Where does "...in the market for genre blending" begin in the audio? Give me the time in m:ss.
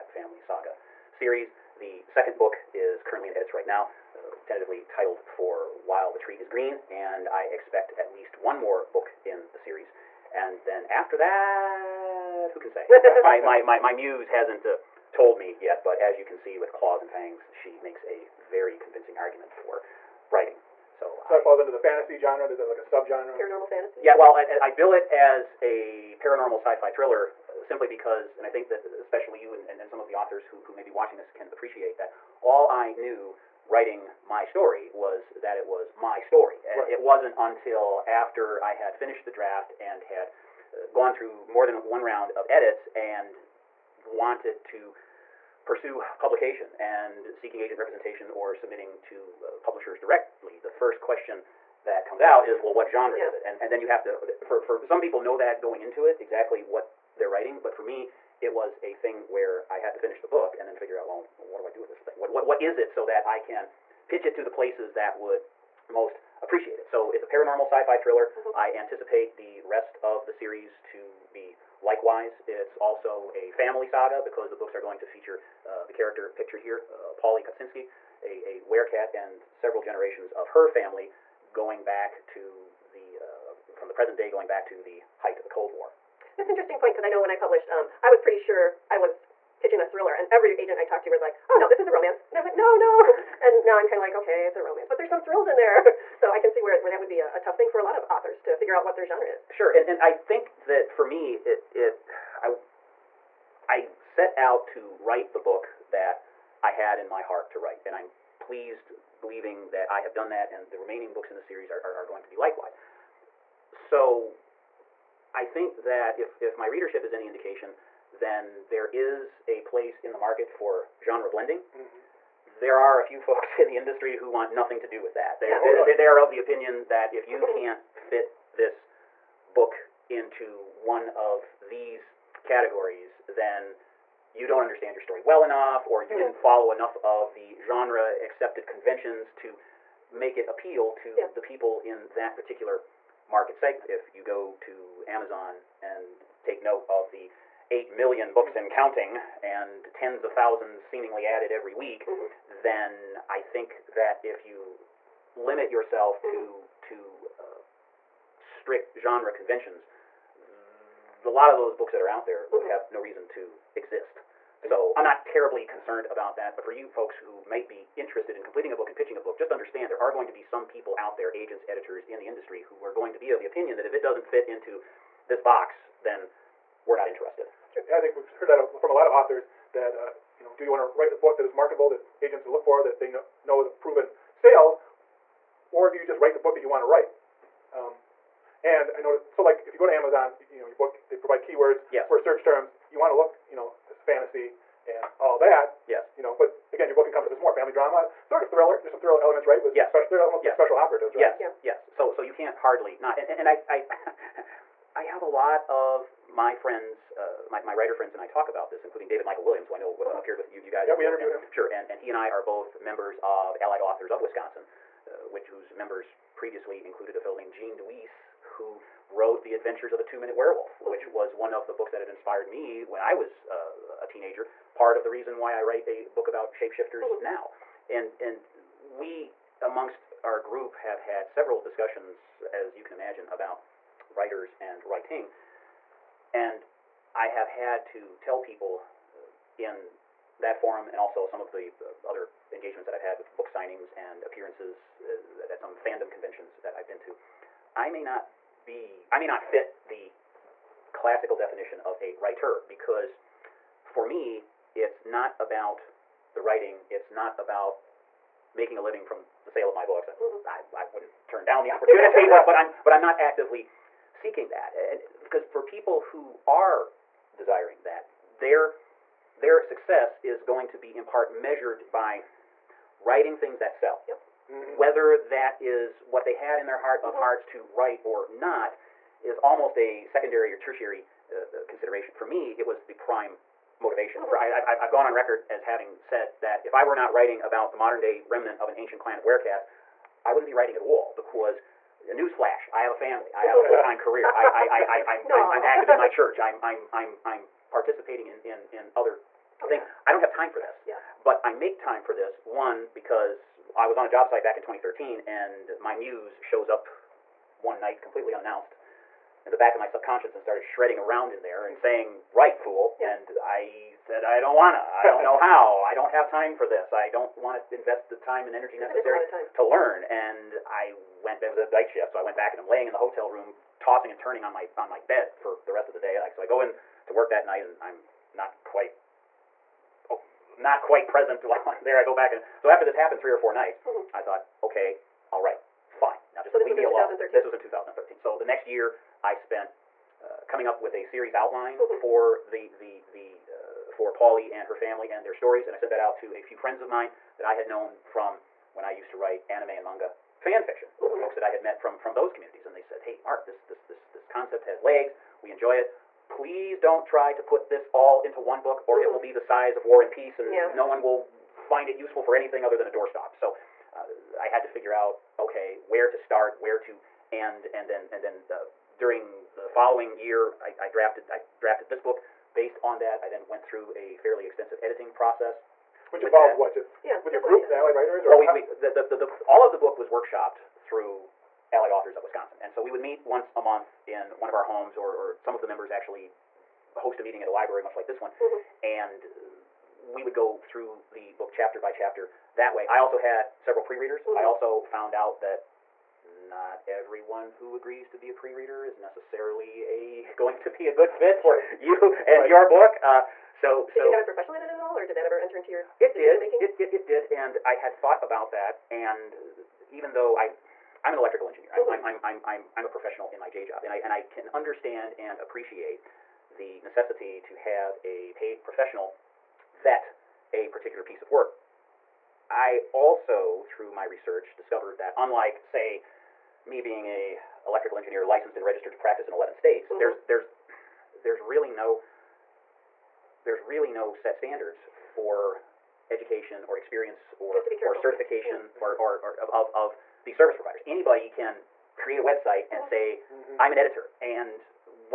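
2:00.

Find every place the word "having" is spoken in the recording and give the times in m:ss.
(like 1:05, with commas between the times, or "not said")
4:45.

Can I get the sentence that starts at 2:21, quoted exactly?
the people in that particular market segment.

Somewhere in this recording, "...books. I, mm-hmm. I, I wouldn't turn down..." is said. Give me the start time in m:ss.
4:19.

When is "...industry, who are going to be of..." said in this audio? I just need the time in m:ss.
2:52.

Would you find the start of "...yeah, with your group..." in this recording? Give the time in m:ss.
6:17.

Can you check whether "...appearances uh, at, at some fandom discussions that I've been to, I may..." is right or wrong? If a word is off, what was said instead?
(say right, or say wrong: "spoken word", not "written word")
wrong: "conventions", not "discussions".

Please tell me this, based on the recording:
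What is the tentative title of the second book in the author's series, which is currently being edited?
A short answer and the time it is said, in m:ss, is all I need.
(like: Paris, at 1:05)
While the Tree is Green, at 0:05.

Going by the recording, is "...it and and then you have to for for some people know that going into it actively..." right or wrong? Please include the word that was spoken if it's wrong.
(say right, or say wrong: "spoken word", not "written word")
wrong: "exactly", not "actively".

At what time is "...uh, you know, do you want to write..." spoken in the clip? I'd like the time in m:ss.
2:59.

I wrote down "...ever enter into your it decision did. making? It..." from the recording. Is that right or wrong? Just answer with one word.
right.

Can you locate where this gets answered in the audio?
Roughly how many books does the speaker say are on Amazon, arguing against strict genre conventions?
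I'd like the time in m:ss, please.
2:27.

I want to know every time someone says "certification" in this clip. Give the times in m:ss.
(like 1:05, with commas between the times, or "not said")
7:17.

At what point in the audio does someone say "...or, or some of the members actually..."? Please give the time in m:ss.
6:24.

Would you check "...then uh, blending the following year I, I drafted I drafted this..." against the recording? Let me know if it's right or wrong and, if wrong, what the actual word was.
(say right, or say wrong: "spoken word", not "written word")
wrong: "during", not "blending".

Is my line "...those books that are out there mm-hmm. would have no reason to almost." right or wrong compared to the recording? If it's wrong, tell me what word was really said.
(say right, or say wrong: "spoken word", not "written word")
wrong: "exist", not "almost".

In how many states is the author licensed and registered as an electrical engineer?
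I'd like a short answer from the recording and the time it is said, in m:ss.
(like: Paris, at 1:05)
11, at 7:09.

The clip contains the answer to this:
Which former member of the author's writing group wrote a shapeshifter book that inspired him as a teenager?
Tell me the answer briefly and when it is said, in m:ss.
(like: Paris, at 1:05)
Gene DeWeese, at 3:37.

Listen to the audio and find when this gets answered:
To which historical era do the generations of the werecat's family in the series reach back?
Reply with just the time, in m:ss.
1:25.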